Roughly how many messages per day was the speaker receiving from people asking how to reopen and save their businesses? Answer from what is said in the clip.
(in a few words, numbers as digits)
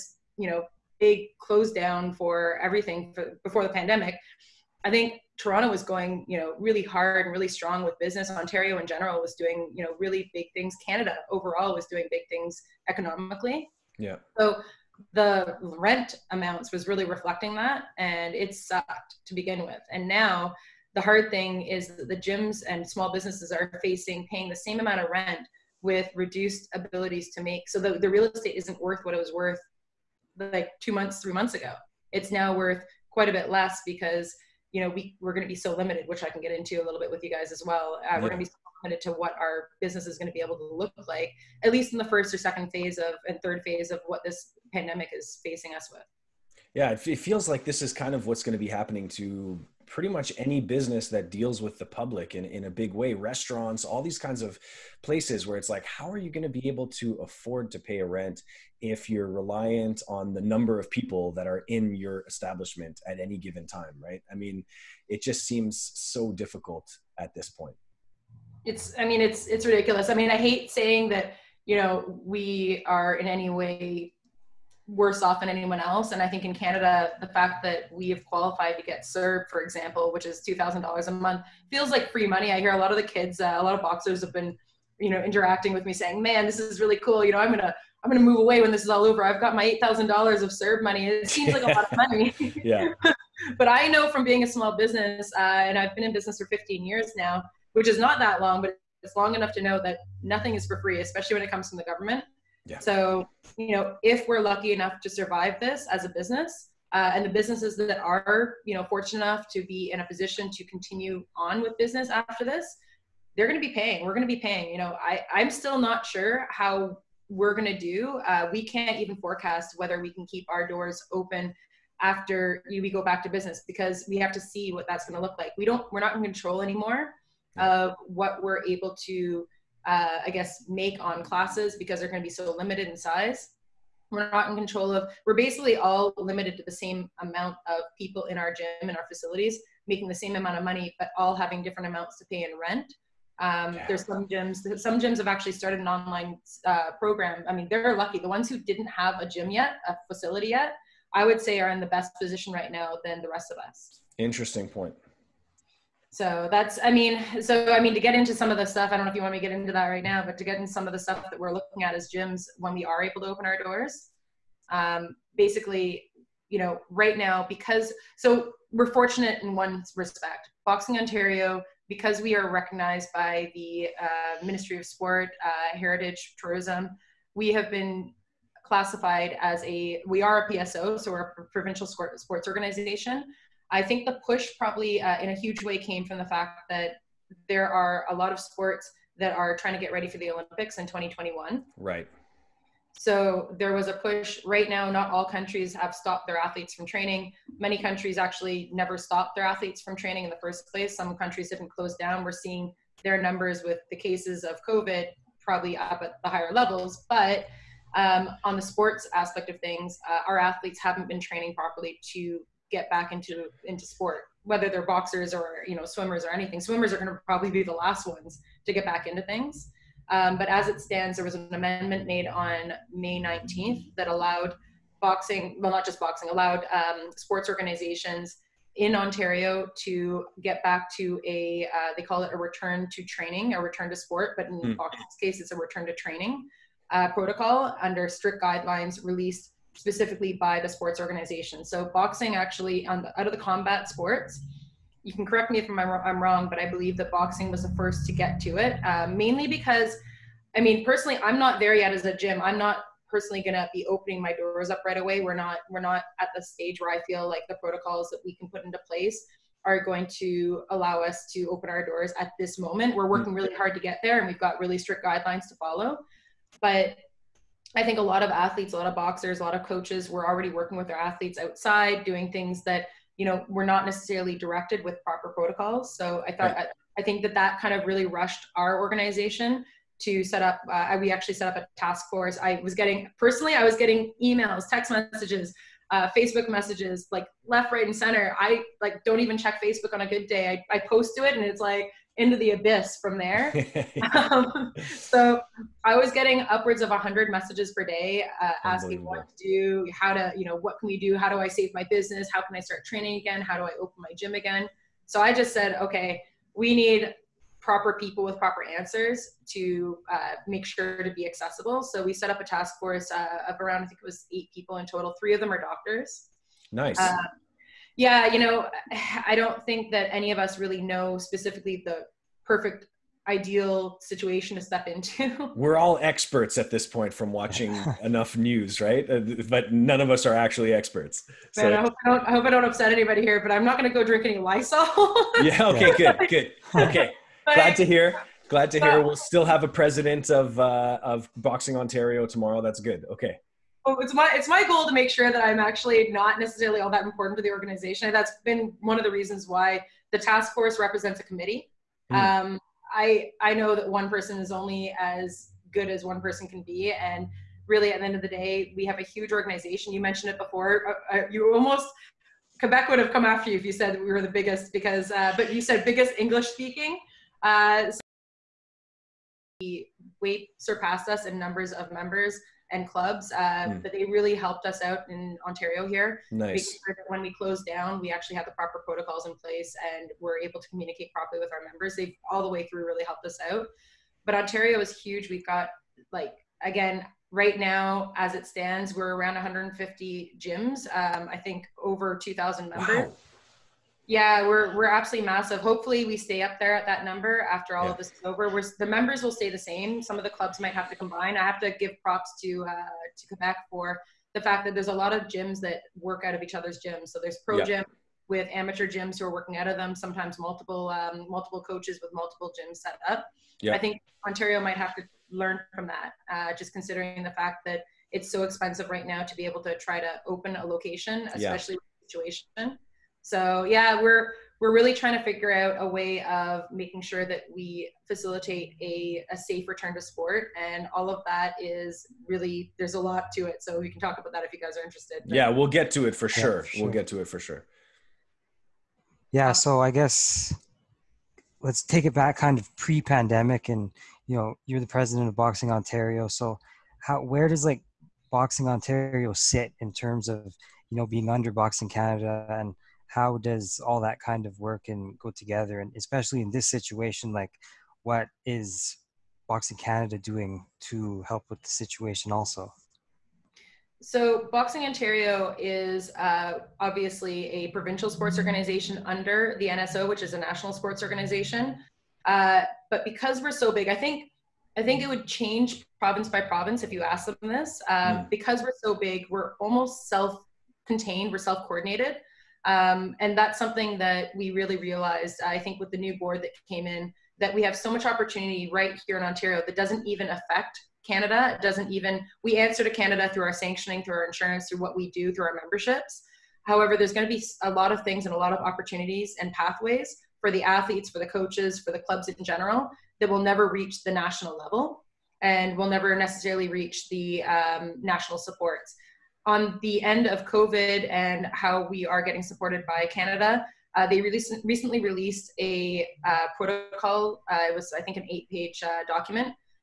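100.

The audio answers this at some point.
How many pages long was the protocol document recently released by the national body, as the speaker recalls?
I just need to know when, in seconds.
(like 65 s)
518 s.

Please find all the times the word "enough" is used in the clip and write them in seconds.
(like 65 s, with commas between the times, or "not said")
99 s, 104 s, 109 s, 328 s.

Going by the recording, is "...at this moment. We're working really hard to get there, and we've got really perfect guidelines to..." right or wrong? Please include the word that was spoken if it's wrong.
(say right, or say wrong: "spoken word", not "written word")
wrong: "strict", not "perfect".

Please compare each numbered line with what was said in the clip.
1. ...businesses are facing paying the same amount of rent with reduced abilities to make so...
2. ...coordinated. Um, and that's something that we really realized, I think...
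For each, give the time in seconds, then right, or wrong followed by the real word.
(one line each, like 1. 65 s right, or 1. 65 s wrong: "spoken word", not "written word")
1. 23 s right
2. 481 s right.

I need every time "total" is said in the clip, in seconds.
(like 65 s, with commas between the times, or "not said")
314 s.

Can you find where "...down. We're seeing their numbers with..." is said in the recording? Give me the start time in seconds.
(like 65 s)
201 s.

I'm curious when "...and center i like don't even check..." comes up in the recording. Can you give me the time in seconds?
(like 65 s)
287 s.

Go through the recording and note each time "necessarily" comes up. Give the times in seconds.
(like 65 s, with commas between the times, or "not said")
273 s, 346 s, 506 s.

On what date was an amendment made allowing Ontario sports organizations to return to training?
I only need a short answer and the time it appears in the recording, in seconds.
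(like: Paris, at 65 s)
May 19th, at 222 s.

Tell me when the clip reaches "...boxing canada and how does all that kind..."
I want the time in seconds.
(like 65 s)
451 s.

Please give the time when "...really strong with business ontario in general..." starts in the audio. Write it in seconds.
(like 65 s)
7 s.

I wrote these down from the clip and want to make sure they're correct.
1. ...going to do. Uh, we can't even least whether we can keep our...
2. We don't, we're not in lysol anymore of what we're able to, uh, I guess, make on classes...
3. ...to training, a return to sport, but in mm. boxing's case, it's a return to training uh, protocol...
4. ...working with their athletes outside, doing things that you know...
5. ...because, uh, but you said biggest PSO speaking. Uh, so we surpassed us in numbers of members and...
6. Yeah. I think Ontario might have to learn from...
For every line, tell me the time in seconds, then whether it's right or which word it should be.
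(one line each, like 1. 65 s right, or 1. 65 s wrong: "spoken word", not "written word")
1. 117 s wrong: "forecast", not "least"
2. 125 s wrong: "control", not "lysol"
3. 232 s right
4. 270 s right
5. 364 s wrong: "English", not "PSO"
6. 413 s right.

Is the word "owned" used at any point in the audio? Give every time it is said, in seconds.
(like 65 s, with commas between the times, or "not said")
not said.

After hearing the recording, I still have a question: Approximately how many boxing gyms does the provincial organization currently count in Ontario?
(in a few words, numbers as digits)
150.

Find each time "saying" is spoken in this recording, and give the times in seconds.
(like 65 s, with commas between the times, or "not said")
70 s, 85 s.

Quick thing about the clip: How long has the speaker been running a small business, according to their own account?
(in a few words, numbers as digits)
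15 years.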